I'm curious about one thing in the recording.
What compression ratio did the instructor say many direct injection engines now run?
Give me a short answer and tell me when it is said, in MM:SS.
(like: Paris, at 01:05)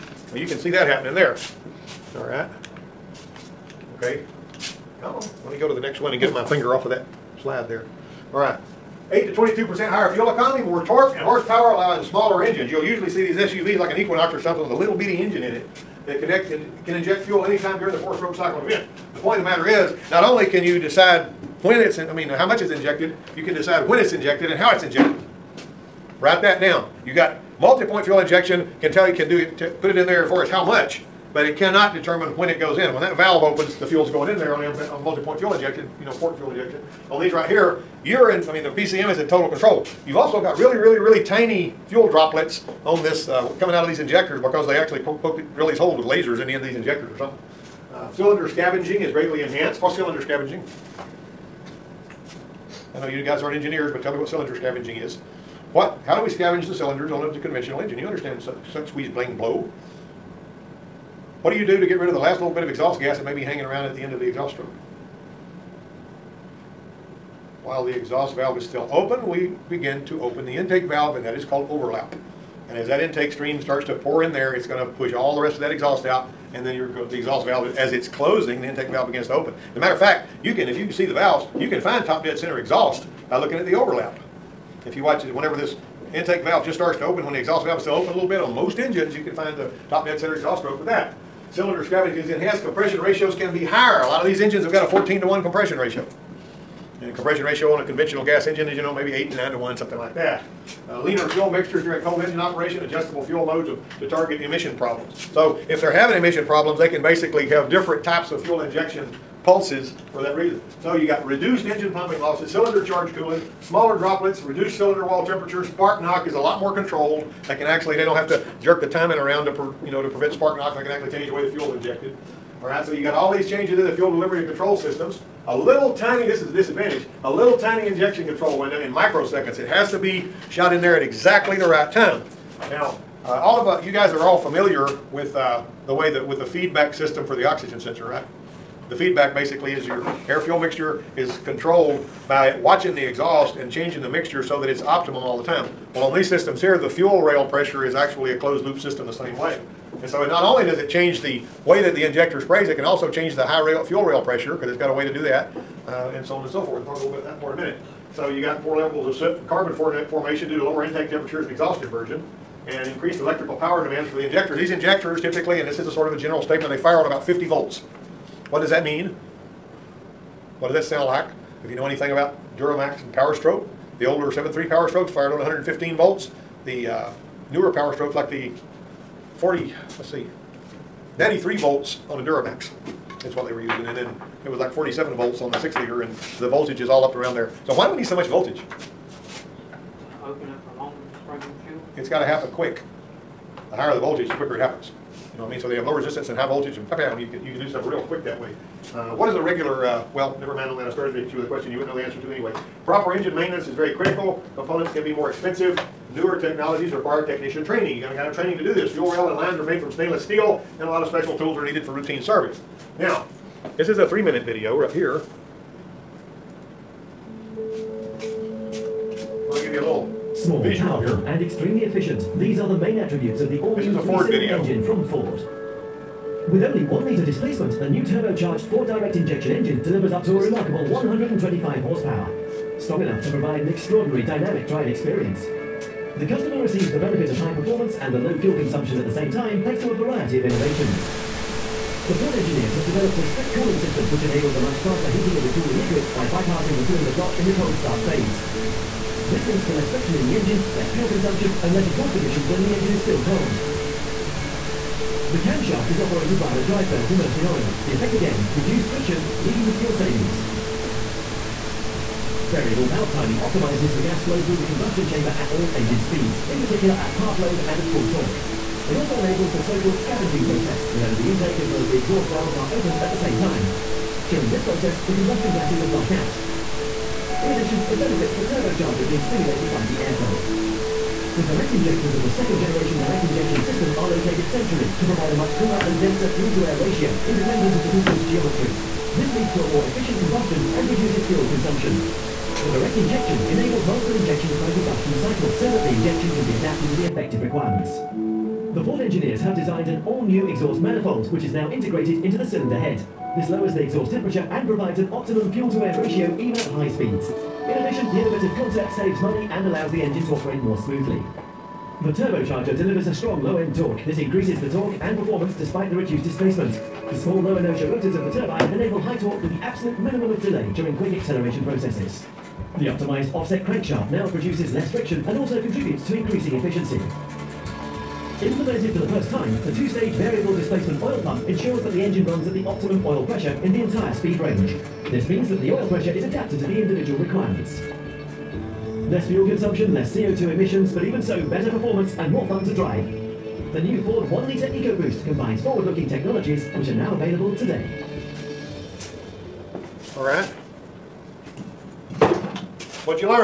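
14 to 1, at 01:34.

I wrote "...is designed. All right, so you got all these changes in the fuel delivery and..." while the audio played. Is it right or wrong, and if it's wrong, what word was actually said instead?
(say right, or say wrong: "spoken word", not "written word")
wrong: "injected", not "designed".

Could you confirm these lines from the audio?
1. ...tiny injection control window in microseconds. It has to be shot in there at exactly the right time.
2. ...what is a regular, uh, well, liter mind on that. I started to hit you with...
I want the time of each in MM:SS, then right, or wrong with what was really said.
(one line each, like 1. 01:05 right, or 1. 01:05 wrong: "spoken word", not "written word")
1. 02:07 right
2. 03:19 wrong: "never", not "liter".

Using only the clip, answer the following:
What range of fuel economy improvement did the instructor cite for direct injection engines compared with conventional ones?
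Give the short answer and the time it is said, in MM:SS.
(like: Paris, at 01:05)
8 to 22%, at 00:09.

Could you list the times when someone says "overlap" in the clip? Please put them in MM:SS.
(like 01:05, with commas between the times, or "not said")
01:11, 01:23.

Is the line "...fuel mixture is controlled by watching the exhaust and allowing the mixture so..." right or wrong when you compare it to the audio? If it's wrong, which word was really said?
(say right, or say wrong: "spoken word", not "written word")
wrong: "changing", not "allowing".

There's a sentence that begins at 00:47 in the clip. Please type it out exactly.
Uh, cylinder scavenging is greatly enhanced.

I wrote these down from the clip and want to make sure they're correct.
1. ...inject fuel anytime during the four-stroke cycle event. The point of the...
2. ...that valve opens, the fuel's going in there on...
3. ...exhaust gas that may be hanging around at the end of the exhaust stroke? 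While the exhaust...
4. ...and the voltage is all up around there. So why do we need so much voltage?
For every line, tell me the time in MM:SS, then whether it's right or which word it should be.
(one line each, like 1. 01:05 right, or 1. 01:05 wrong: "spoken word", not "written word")
1. 00:16 right
2. 00:33 right
3. 01:02 right
4. 03:06 right.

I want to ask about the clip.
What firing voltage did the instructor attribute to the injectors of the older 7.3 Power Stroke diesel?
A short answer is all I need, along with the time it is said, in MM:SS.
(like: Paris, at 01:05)
115 volts, at 02:55.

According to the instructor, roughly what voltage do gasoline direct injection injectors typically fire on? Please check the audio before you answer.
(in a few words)
50 volts.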